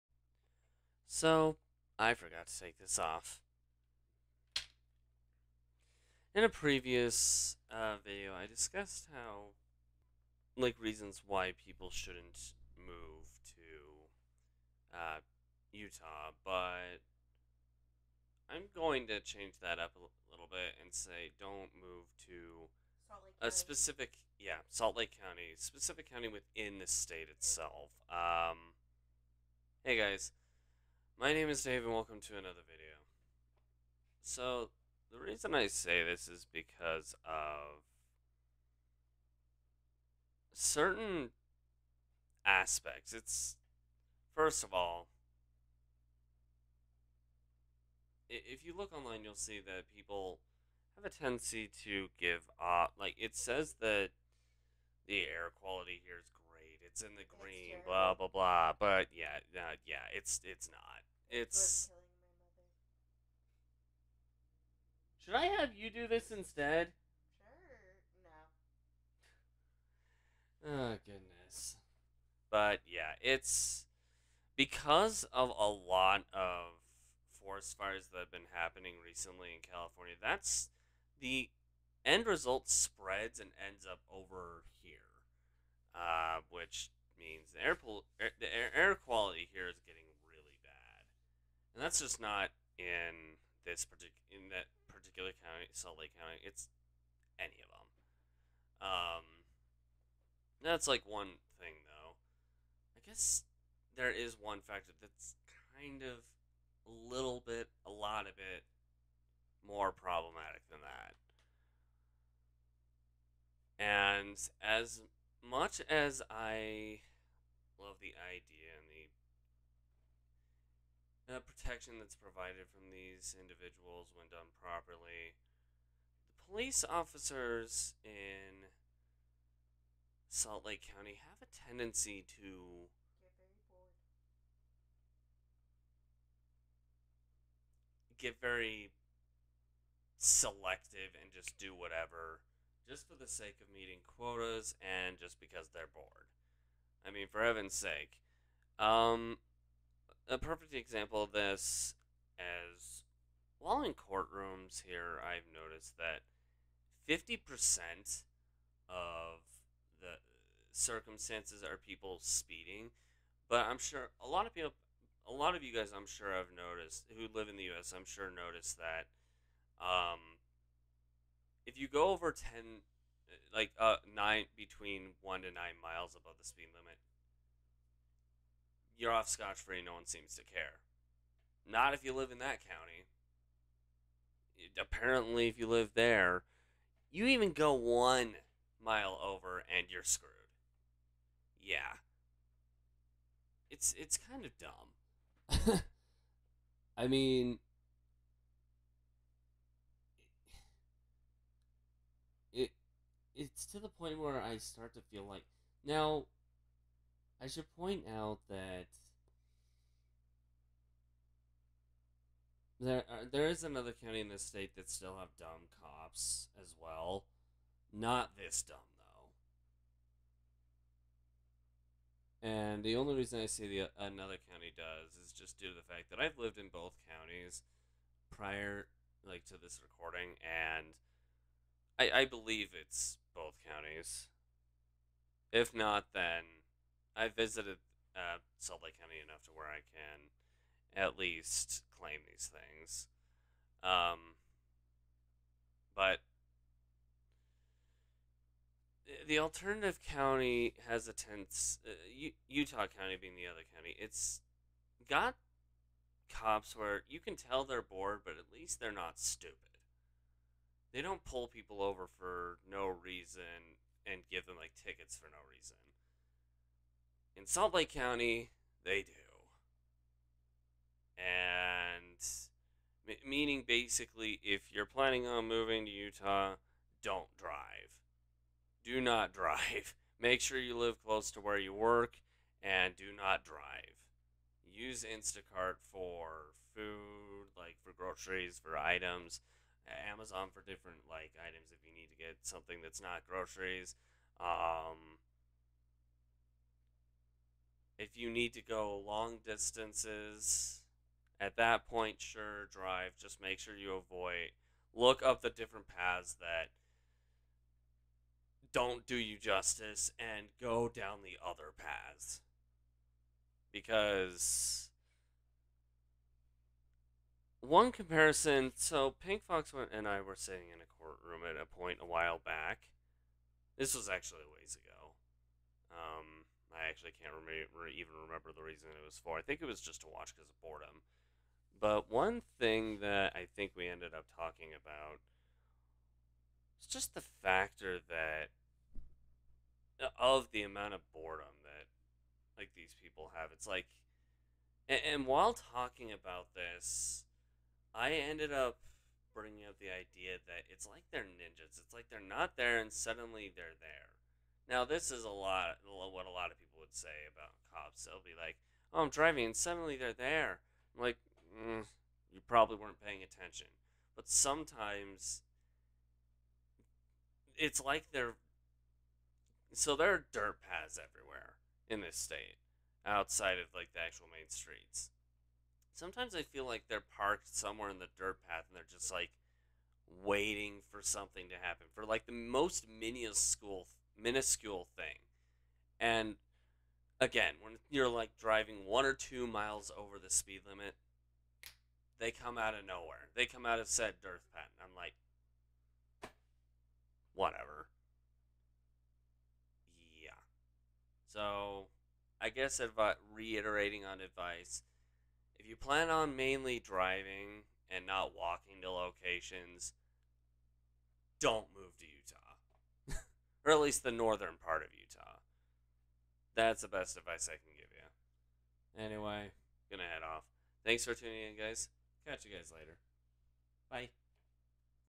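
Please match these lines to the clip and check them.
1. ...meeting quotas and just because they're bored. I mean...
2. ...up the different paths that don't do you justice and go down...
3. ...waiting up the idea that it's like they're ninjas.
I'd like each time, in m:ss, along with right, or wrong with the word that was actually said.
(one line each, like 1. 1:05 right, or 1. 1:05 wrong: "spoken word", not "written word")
1. 2:23 right
2. 5:05 right
3. 5:49 wrong: "bringing", not "waiting".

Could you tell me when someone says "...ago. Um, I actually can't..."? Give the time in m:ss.
5:24.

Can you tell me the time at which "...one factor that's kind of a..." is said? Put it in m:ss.
1:44.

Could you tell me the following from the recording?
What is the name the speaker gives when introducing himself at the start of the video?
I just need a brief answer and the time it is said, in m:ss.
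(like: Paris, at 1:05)
Dave, at 0:31.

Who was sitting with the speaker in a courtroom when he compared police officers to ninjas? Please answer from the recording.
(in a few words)
Pink Fox.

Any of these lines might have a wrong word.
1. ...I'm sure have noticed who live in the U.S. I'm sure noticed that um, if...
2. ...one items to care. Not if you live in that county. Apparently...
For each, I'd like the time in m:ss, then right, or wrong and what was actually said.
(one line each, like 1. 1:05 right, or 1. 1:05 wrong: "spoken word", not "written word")
1. 2:45 right
2. 2:59 wrong: "seems", not "items".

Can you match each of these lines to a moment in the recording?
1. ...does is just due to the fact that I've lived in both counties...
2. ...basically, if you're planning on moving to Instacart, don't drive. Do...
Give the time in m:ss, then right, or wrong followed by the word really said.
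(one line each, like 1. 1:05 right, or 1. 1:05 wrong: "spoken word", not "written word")
1. 3:44 right
2. 4:33 wrong: "Utah", not "Instacart".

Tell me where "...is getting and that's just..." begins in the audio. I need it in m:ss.
1:29.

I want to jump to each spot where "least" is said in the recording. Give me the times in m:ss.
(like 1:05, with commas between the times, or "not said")
4:01, 4:18, 6:53.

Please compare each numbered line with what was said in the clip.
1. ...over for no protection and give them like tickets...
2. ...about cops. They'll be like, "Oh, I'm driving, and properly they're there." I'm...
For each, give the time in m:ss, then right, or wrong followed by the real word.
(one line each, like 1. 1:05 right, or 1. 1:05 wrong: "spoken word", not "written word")
1. 4:21 wrong: "reason", not "protection"
2. 5:57 wrong: "suddenly", not "properly".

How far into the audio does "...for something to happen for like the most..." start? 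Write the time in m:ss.
6:20.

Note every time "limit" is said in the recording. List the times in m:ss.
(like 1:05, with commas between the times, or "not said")
2:56, 6:30.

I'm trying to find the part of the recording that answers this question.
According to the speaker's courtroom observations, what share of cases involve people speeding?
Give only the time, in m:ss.
2:37.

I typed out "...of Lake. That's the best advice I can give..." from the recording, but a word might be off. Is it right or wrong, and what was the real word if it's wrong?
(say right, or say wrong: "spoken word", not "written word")
wrong: "Utah", not "Lake".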